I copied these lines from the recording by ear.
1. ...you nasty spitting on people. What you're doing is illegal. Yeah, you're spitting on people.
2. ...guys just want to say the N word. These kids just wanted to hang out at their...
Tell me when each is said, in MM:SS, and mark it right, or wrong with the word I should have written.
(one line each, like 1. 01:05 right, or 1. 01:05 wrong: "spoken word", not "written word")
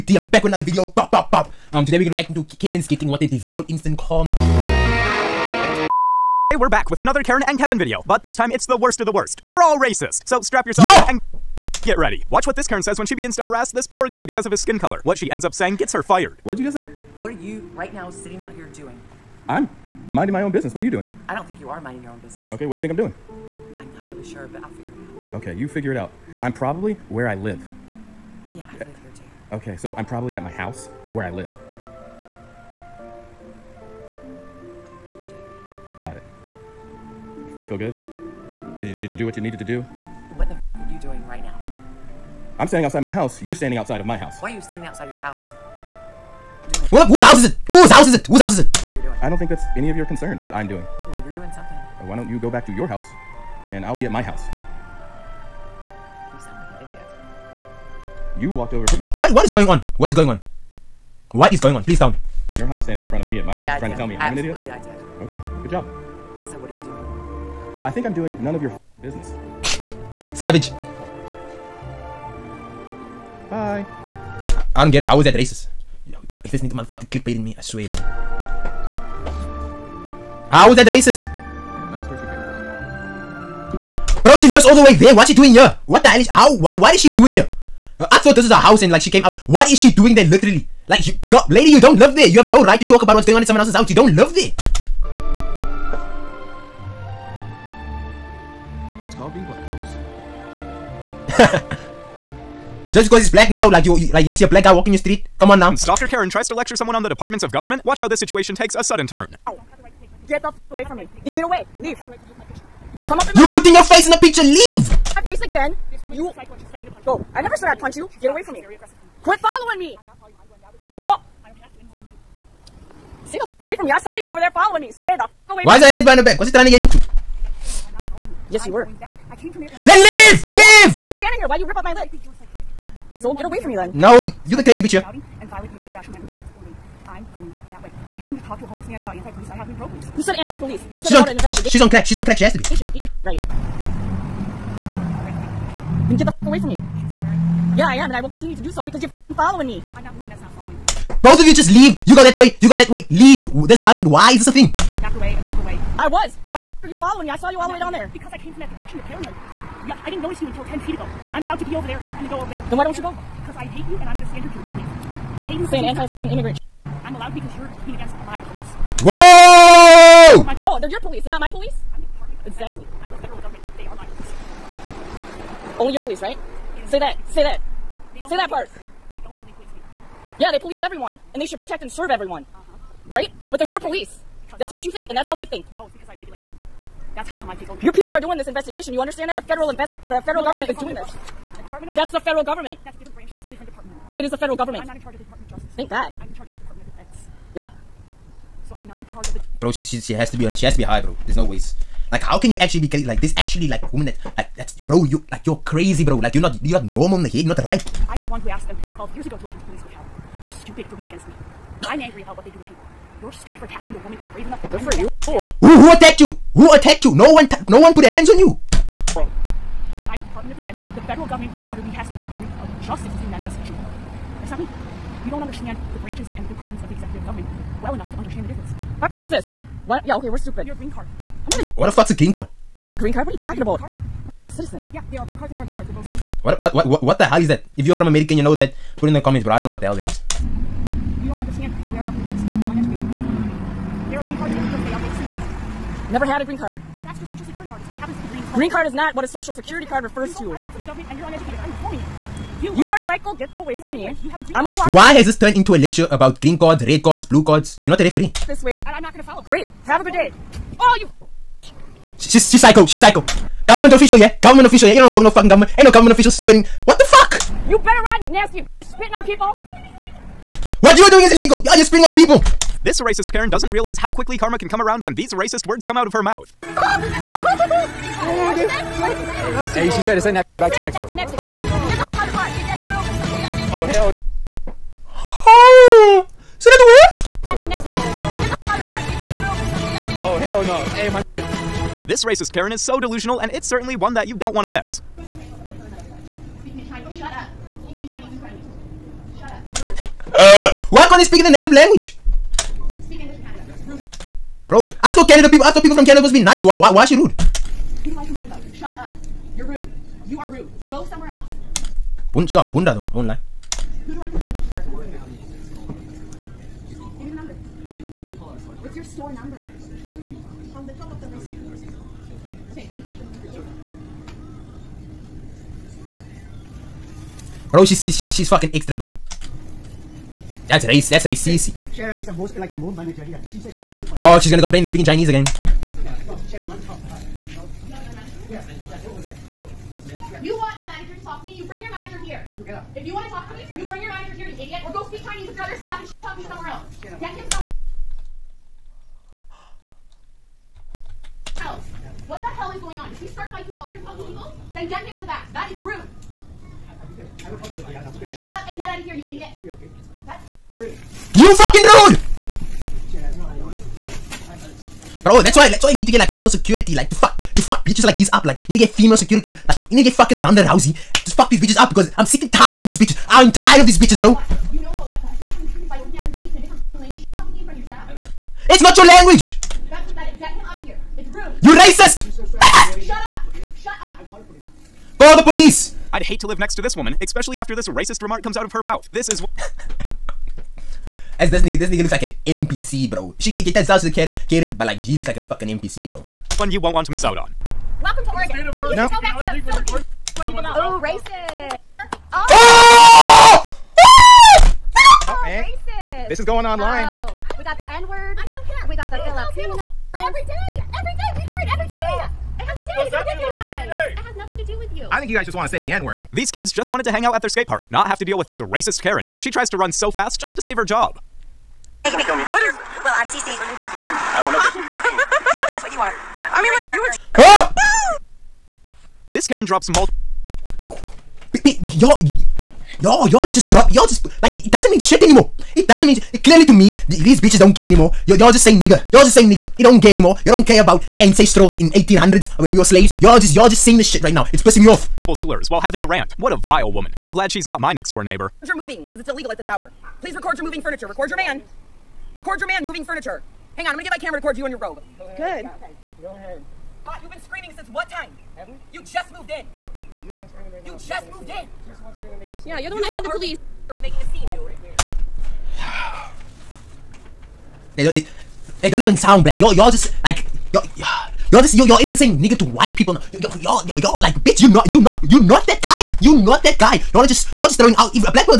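1. 04:28 right
2. 06:55 right.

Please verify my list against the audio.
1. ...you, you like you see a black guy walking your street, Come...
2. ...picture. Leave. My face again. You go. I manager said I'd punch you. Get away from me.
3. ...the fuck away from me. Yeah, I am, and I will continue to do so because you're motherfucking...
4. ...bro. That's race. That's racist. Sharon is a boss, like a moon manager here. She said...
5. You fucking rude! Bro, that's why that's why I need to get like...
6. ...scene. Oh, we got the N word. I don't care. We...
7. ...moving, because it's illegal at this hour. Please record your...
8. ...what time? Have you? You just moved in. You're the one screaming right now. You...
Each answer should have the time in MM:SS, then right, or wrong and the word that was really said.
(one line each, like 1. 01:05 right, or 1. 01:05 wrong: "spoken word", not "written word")
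1. 01:43 right
2. 01:54 wrong: "never", not "manager"
3. 02:26 wrong: "following", not "motherfucking"
4. 05:28 right
5. 06:01 right
6. 06:46 wrong: "online", not "scene"
7. 07:28 right
8. 07:37 right.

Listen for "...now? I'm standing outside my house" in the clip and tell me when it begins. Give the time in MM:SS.
00:41.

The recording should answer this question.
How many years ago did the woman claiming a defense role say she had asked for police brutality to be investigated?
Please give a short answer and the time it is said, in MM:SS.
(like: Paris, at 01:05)
12 years, at 03:28.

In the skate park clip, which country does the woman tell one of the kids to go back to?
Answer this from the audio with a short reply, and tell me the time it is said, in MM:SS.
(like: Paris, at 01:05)
Philippines, at 06:39.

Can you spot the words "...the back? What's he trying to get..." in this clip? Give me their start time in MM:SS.
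02:06.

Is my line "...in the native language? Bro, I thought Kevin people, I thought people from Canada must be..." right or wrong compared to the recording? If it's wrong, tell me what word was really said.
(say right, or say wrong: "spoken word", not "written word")
wrong: "Canada", not "Kevin".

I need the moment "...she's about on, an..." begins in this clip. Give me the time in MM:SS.
02:21.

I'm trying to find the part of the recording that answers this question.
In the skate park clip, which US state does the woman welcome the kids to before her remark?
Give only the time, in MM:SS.
06:38.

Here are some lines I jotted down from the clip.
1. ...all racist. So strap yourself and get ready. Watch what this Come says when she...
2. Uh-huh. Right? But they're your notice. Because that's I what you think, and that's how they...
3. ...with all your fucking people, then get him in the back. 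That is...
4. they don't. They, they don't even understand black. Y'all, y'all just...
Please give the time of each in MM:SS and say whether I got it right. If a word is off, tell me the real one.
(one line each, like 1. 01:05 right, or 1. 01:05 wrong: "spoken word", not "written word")
1. 00:09 wrong: "Karen", not "Come"
2. 03:02 wrong: "police", not "notice"
3. 05:53 right
4. 07:47 wrong: "sound", not "understand".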